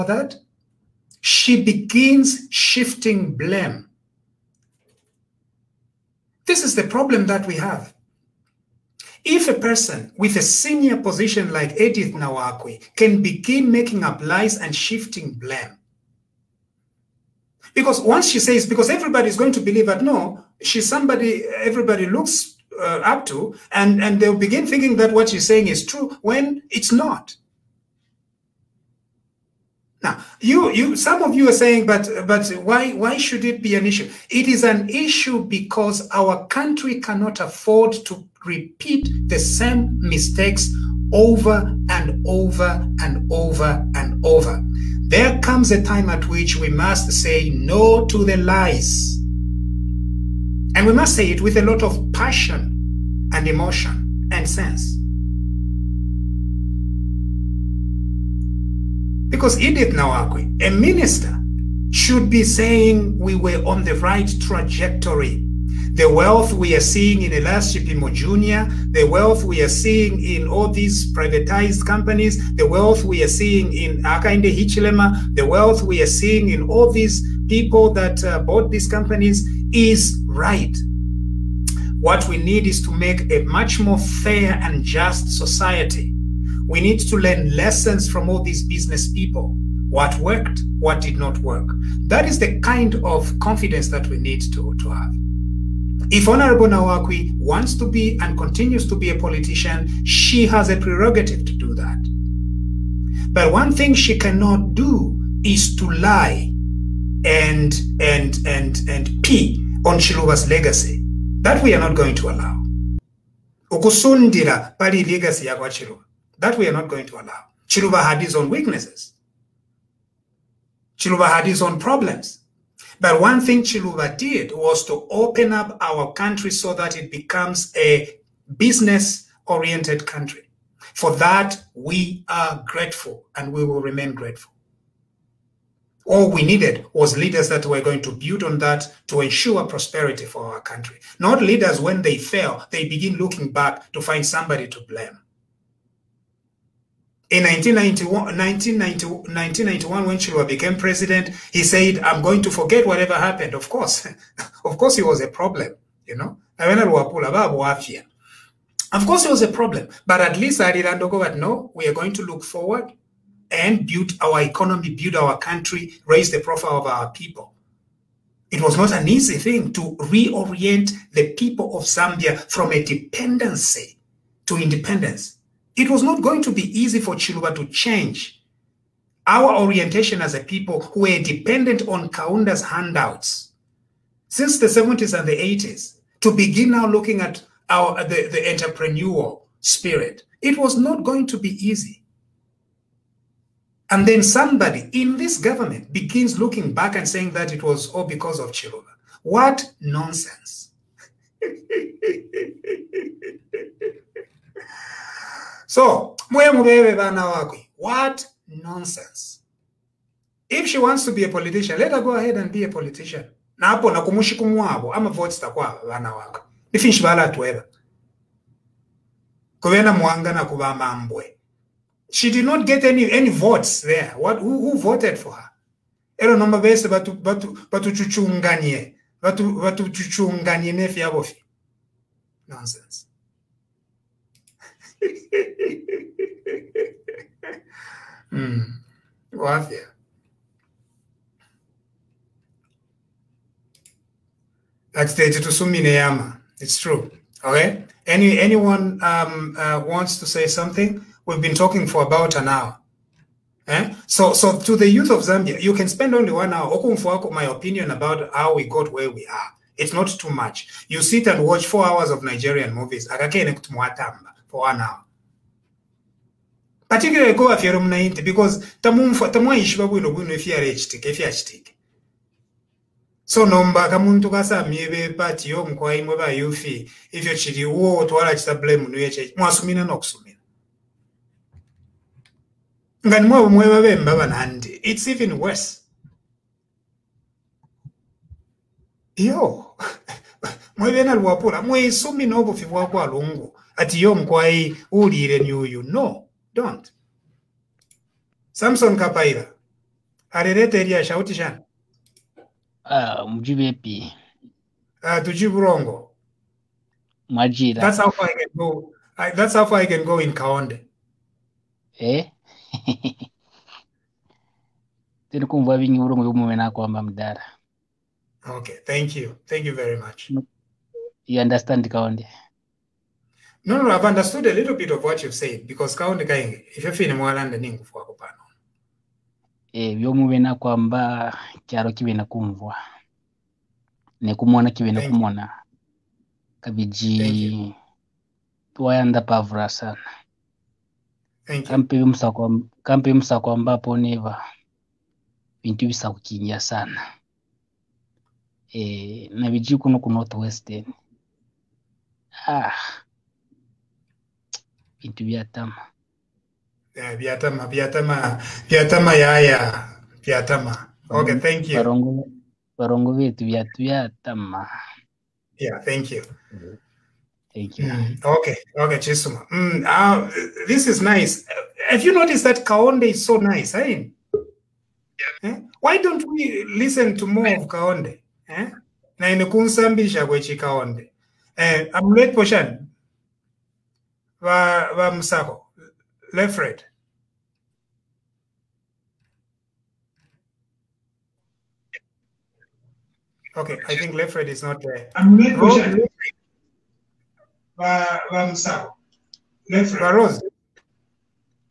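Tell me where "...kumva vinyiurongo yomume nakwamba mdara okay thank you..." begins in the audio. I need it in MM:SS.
05:15.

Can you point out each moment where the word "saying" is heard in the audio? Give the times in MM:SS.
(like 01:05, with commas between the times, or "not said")
00:25, 00:31, 01:02, 03:17.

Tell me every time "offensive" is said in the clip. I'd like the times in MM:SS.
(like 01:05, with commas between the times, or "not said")
not said.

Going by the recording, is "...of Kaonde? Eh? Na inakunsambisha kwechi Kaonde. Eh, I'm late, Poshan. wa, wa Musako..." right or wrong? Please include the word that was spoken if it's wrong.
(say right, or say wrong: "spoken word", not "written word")
right.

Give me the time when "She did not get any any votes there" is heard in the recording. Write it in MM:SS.
03:42.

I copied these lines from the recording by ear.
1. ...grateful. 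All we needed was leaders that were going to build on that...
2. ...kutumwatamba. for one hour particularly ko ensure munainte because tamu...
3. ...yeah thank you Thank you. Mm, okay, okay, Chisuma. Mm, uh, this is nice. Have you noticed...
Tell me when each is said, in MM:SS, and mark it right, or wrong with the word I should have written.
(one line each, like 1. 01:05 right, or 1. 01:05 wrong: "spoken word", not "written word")
1. 02:14 right
2. 04:23 wrong: "afyere", not "ensure"
3. 06:05 right.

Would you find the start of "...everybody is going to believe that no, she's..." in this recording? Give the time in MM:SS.
00:18.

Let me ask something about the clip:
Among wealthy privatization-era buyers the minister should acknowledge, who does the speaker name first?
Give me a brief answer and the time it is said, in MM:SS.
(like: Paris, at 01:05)
Elias Chipimo Jr., at 01:07.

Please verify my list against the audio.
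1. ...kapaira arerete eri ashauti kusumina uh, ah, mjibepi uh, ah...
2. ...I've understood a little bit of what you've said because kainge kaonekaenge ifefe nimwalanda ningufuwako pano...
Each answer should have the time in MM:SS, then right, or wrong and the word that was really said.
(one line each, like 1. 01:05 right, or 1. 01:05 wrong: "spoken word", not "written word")
1. 04:58 wrong: "shana", not "kusumina"
2. 05:23 right.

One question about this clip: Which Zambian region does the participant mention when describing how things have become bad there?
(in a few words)
Northwestern.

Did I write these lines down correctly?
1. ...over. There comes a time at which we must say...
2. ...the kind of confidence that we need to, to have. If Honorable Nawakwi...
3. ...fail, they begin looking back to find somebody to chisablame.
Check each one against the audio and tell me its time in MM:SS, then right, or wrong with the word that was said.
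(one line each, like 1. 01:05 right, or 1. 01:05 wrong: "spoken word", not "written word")
1. 00:44 right
2. 01:32 right
3. 02:22 wrong: "blame", not "chisablame".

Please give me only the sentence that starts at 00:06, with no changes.
This is the problem that we have.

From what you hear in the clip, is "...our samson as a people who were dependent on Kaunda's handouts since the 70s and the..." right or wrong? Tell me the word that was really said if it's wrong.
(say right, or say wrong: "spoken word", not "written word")
wrong: "orientation", not "samson".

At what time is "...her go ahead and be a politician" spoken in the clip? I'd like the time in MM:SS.
03:31.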